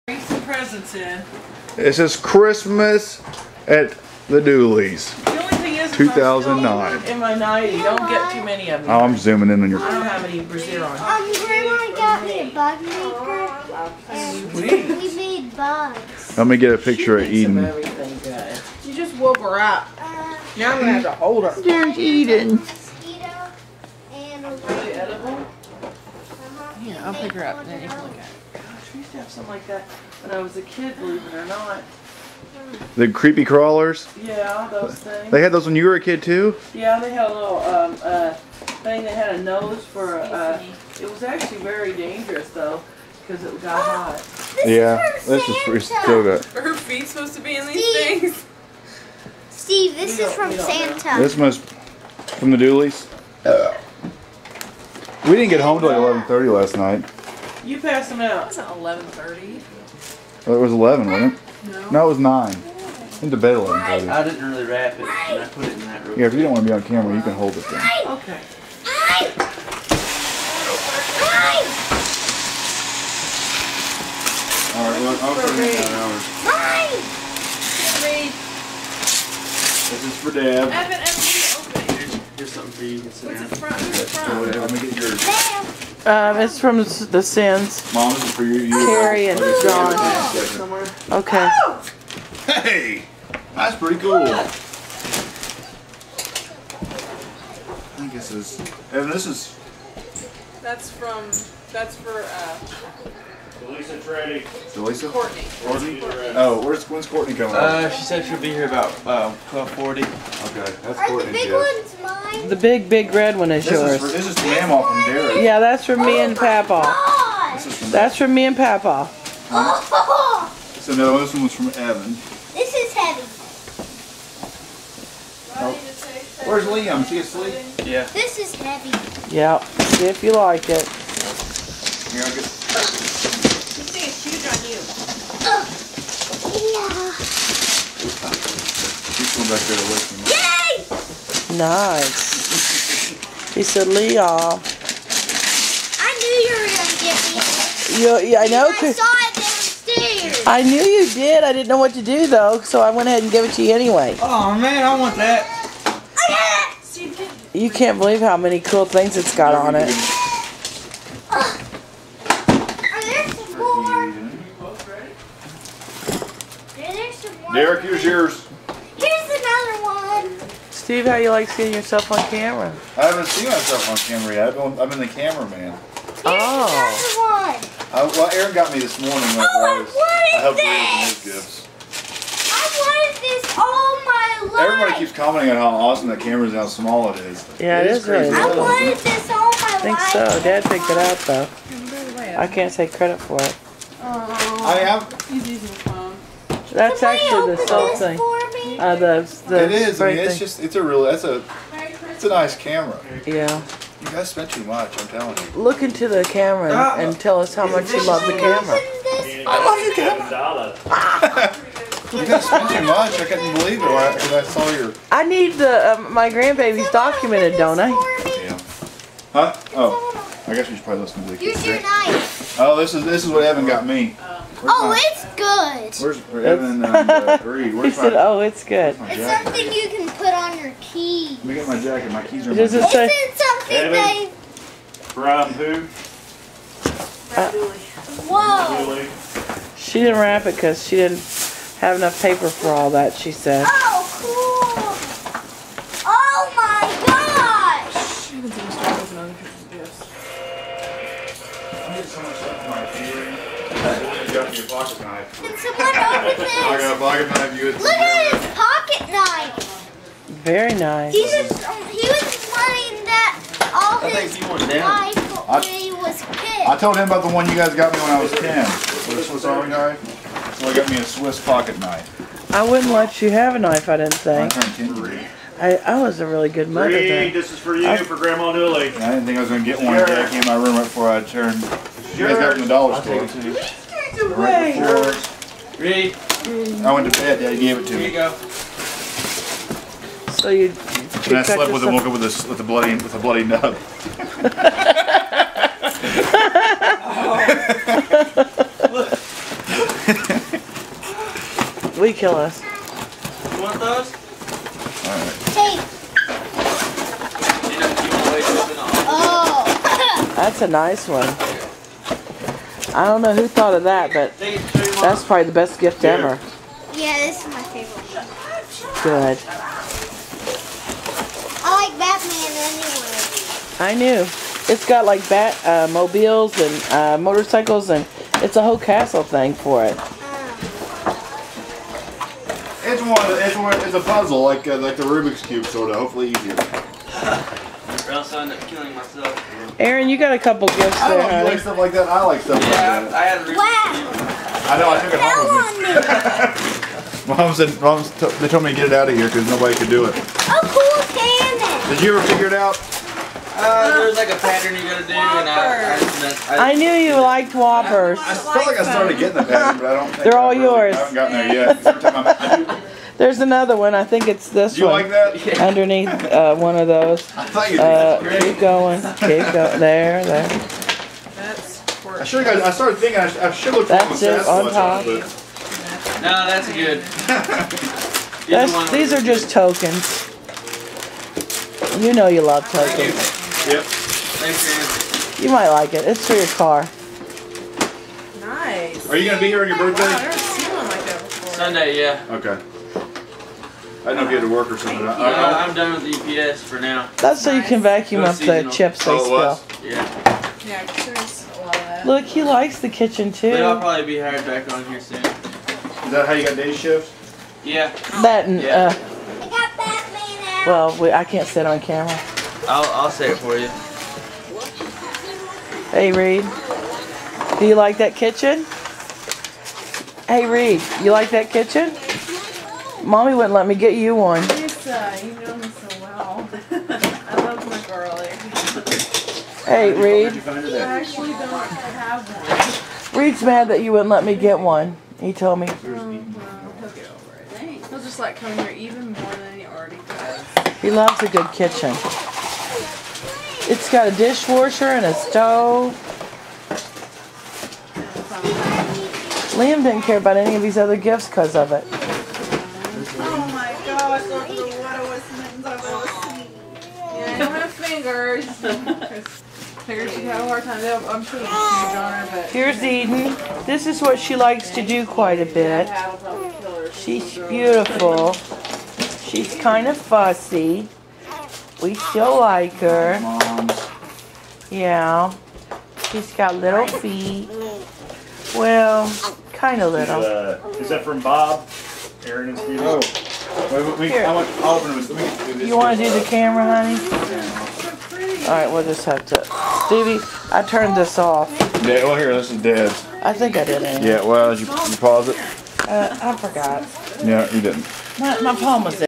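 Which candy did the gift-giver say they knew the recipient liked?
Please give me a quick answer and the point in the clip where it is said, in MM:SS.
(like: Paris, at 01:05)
Whoppers, at 05:57.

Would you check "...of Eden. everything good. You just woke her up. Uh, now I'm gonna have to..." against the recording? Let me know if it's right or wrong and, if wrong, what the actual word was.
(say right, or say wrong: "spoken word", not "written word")
right.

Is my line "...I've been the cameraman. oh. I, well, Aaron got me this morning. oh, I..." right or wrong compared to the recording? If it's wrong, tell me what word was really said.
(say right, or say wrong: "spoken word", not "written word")
right.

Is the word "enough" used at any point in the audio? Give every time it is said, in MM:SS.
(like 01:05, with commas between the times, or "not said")
04:01.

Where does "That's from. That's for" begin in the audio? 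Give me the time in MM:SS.
01:40.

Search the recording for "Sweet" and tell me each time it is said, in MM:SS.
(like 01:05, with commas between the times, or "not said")
00:14.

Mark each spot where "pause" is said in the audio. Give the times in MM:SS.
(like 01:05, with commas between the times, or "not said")
08:14.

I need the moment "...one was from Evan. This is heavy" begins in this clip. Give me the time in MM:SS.
02:01.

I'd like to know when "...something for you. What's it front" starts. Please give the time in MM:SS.
01:22.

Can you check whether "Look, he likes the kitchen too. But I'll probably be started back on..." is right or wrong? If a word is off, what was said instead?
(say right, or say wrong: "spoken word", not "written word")
wrong: "hired", not "started".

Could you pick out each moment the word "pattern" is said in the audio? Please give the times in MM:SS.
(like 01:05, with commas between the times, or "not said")
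05:54, 05:59.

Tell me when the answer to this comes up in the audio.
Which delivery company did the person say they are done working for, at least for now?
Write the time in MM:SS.
06:36.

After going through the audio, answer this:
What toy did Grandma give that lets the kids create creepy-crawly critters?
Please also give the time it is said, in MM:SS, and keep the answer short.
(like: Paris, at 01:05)
A bug maker, at 00:12.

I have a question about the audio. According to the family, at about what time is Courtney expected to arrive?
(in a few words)
12:40.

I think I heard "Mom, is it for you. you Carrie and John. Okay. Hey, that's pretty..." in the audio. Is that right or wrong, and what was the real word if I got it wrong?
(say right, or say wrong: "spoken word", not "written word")
right.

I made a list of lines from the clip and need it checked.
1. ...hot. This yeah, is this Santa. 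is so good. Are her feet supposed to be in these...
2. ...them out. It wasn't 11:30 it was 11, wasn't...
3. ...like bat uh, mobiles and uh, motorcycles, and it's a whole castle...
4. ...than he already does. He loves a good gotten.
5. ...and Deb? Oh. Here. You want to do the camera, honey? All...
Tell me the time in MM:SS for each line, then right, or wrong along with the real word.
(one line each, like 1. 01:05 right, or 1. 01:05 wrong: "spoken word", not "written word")
1. 00:43 right
2. 00:58 right
3. 05:25 right
4. 07:19 wrong: "kitchen", not "gotten"
5. 08:02 wrong: "Steve", not "Deb".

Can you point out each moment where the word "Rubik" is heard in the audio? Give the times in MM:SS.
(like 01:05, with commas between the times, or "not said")
05:35.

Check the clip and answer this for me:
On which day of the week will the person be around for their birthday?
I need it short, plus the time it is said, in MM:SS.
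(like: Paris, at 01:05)
Sunday, at 06:31.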